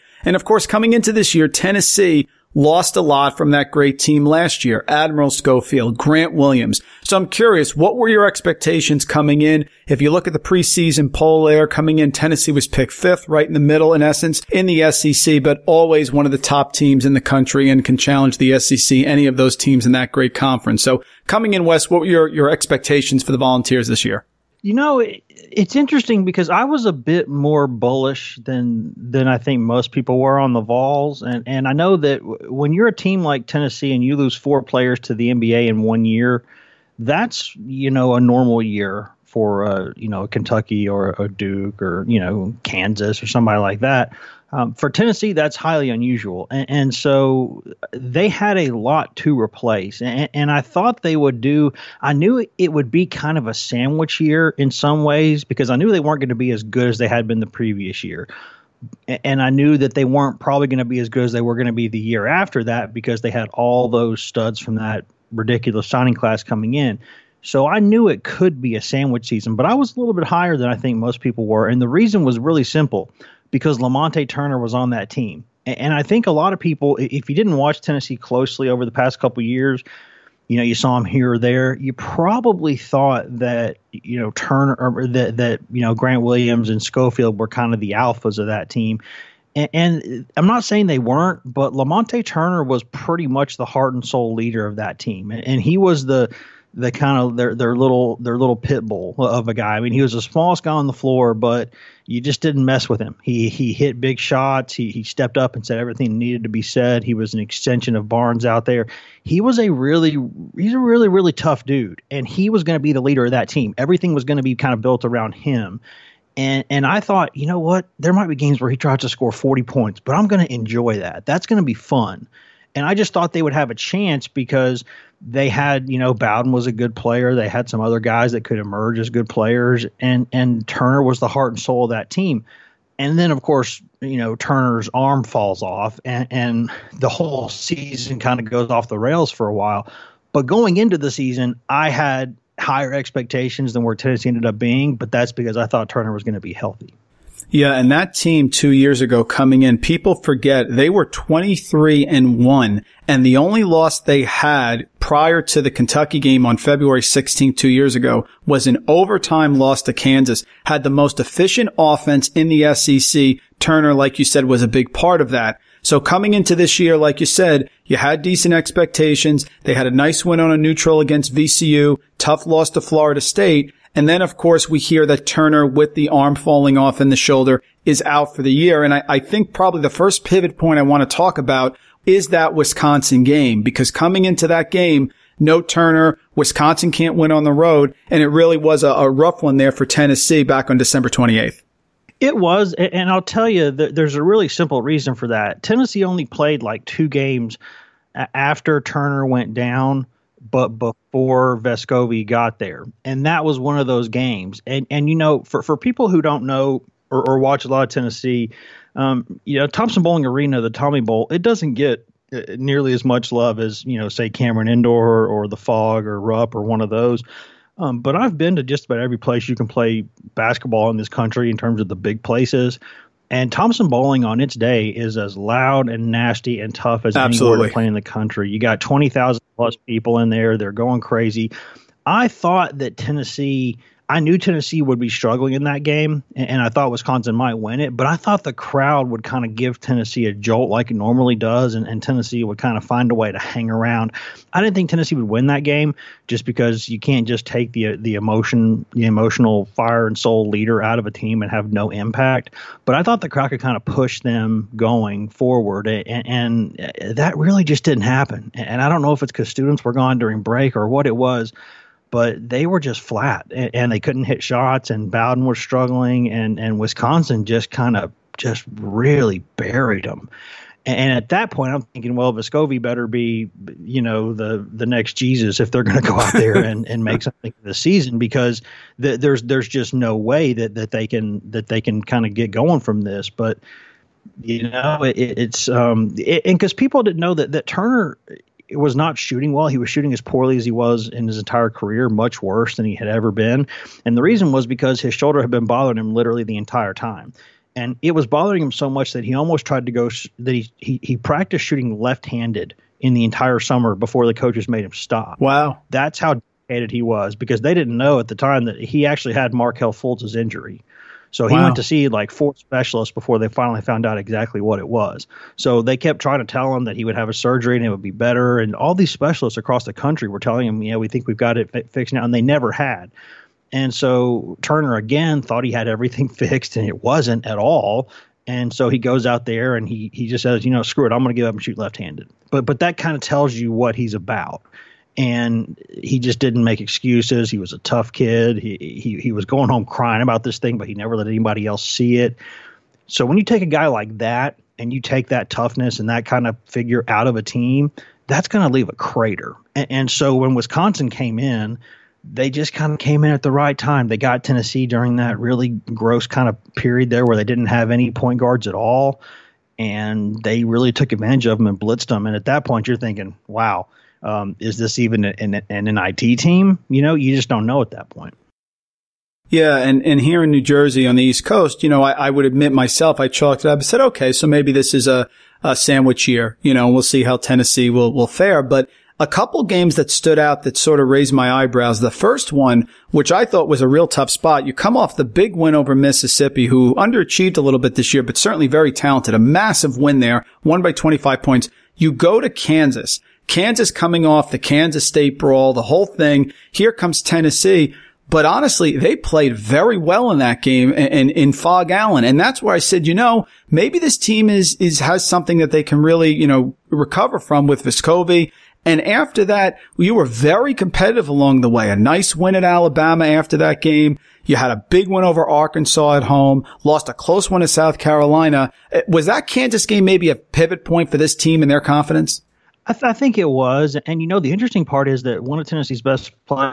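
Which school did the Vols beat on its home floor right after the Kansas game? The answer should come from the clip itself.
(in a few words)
Alabama.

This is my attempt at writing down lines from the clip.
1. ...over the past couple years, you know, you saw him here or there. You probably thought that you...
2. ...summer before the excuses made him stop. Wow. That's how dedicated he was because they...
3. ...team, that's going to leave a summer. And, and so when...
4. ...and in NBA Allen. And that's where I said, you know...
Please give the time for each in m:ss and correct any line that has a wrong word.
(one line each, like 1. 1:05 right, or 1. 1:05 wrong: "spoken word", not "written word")
1. 1:18 right
2. 5:03 wrong: "coaches", not "excuses"
3. 5:47 wrong: "crater", not "summer"
4. 6:40 wrong: "Phog", not "NBA".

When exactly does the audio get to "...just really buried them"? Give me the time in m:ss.
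4:28.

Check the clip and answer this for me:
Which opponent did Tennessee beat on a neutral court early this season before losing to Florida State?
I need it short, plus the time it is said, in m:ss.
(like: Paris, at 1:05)
VCU, at 2:51.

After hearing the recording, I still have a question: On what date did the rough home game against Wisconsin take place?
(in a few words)
December 28th.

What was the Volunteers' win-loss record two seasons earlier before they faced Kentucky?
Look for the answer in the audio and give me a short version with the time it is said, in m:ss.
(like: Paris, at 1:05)
23-1, at 2:31.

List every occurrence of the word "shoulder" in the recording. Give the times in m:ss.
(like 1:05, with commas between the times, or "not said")
2:57, 4:55.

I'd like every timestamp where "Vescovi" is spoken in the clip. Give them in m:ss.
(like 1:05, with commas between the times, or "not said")
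3:21, 4:32, 6:47.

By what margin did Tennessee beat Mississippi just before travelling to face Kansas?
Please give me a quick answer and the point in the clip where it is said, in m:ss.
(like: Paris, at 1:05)
25 points, at 6:30.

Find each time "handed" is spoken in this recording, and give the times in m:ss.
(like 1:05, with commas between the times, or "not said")
5:01, 5:31.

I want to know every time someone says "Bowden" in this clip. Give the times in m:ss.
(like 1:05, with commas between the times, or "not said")
2:06, 4:25.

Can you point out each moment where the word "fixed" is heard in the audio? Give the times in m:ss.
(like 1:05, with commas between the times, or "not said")
5:21, 5:26.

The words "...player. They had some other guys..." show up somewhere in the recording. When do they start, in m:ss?
2:06.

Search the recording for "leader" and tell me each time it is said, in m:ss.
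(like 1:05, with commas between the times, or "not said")
1:34, 1:53, 4:10.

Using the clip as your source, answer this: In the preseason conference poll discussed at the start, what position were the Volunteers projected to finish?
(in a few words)
5th.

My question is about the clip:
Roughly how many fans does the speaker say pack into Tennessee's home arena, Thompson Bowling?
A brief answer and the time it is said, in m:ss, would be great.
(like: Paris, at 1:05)
20,000 plus, at 3:48.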